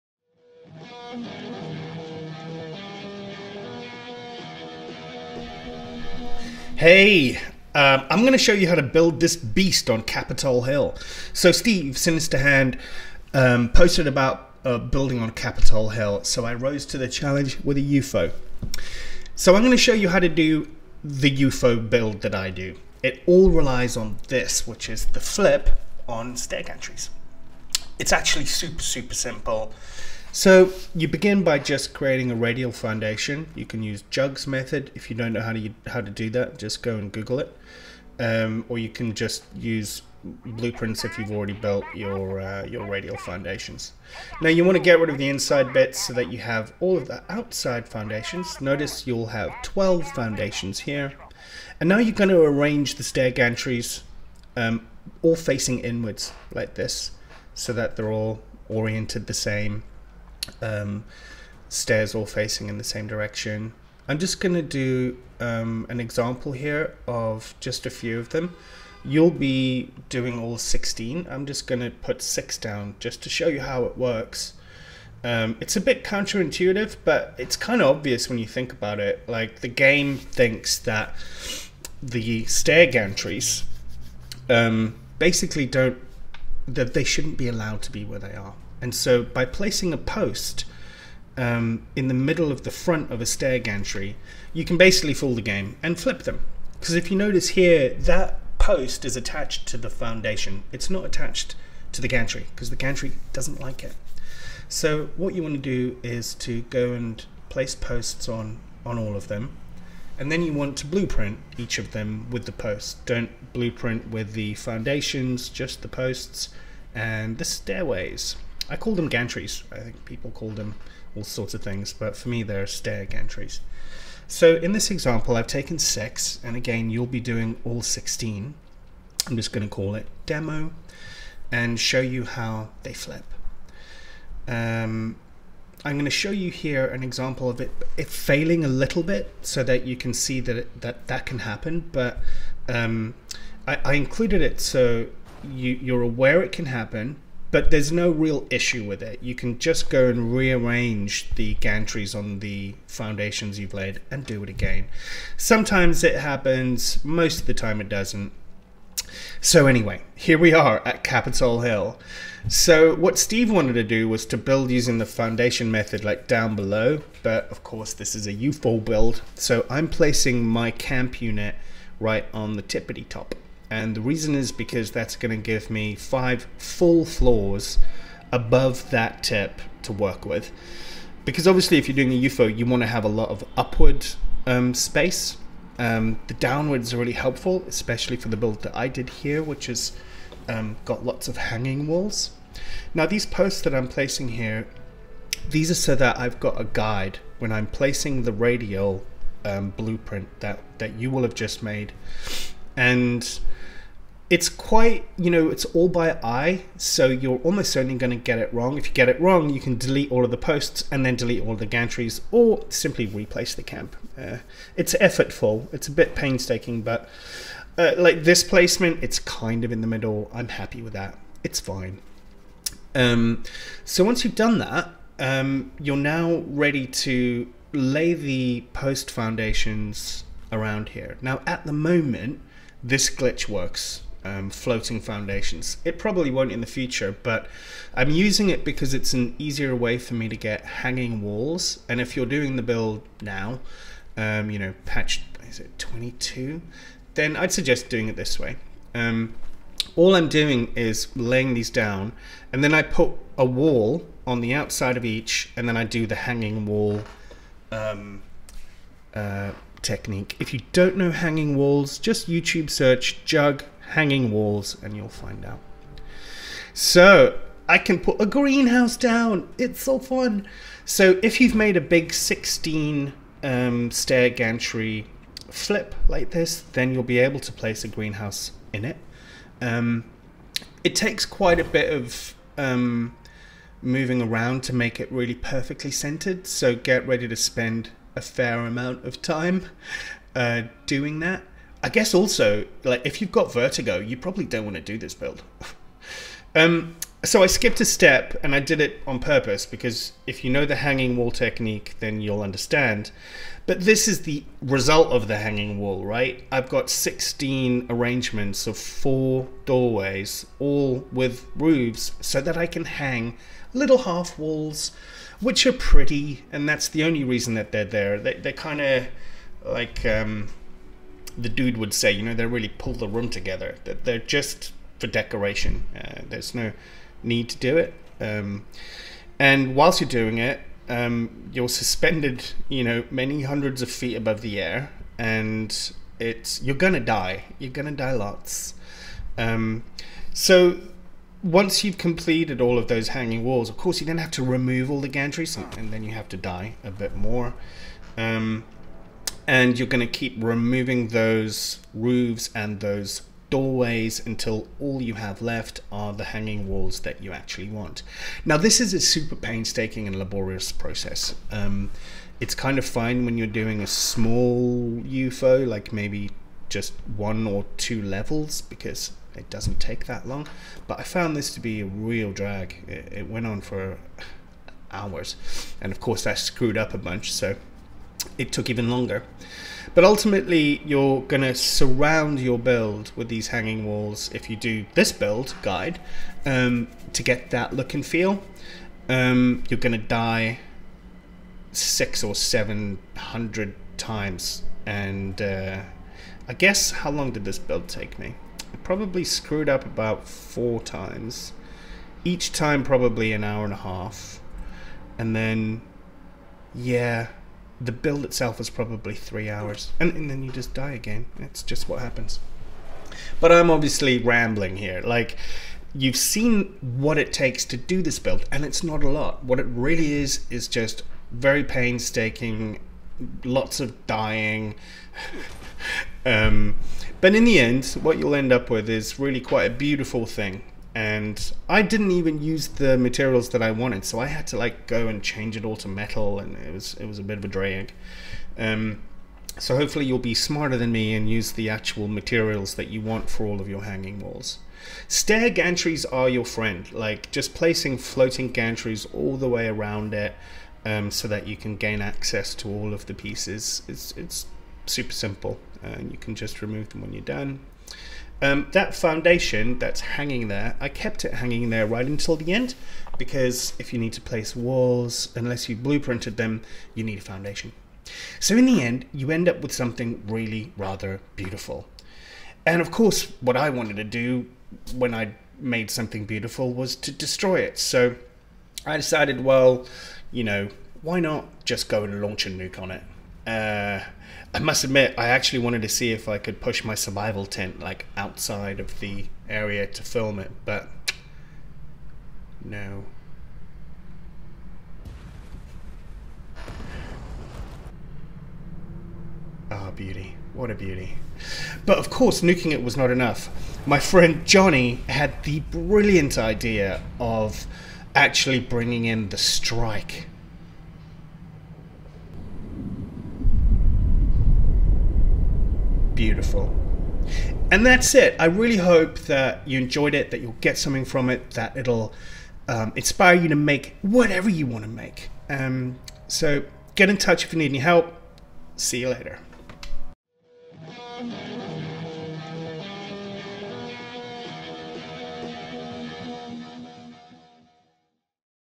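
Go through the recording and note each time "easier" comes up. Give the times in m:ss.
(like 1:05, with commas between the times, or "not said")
3:59.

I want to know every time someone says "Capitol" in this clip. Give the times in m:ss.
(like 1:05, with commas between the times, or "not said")
0:10, 0:15, 2:41.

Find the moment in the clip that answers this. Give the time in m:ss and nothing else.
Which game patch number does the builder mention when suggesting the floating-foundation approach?
4:05.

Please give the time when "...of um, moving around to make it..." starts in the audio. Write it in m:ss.
4:41.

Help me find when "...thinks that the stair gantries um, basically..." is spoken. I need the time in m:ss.
1:20.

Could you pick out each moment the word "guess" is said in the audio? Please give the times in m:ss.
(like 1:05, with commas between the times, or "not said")
4:51, 6:36.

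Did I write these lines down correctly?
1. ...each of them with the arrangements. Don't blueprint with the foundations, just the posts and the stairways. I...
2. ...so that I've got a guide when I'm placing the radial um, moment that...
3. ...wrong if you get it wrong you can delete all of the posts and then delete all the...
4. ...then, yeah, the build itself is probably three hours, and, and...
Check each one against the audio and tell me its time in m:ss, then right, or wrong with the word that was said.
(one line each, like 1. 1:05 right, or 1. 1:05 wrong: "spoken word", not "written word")
1. 1:51 wrong: "posts", not "arrangements"
2. 3:15 wrong: "blueprint", not "moment"
3. 3:28 right
4. 6:45 right.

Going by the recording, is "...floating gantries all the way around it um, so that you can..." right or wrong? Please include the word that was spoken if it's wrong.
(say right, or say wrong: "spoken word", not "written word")
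right.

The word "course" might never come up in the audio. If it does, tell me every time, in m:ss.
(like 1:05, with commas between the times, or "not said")
2:47, 5:43, 6:15, 7:52, 8:22.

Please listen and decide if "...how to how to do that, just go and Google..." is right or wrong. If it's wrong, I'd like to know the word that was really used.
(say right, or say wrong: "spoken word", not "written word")
right.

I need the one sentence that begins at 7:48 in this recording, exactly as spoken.
So in the end, you end up with something really rather beautiful.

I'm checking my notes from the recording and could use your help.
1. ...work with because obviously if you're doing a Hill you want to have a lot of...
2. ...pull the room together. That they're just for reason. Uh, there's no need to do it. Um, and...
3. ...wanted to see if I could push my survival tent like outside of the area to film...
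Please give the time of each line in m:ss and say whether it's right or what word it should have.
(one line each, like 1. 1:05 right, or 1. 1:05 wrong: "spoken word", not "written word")
1. 2:59 wrong: "UFO", not "Hill"
2. 5:22 wrong: "decoration", not "reason"
3. 8:05 right.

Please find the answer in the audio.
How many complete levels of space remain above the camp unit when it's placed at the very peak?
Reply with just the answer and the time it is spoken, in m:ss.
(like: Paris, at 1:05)
5, at 2:55.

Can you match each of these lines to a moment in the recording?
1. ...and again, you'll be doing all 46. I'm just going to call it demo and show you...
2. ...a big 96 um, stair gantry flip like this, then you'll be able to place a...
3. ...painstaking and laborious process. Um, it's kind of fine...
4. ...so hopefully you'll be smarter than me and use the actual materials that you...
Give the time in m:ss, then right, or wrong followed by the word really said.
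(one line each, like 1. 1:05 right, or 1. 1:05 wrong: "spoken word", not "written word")
1. 2:06 wrong: "16", not "46"
2. 4:31 wrong: "16", not "96"
3. 5:59 right
4. 7:19 right.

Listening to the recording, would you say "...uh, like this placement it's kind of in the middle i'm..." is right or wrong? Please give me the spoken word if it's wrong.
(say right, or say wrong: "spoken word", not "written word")
right.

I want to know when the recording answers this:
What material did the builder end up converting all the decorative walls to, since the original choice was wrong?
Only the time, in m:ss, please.
7:15.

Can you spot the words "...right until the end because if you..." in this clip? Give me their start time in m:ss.
7:41.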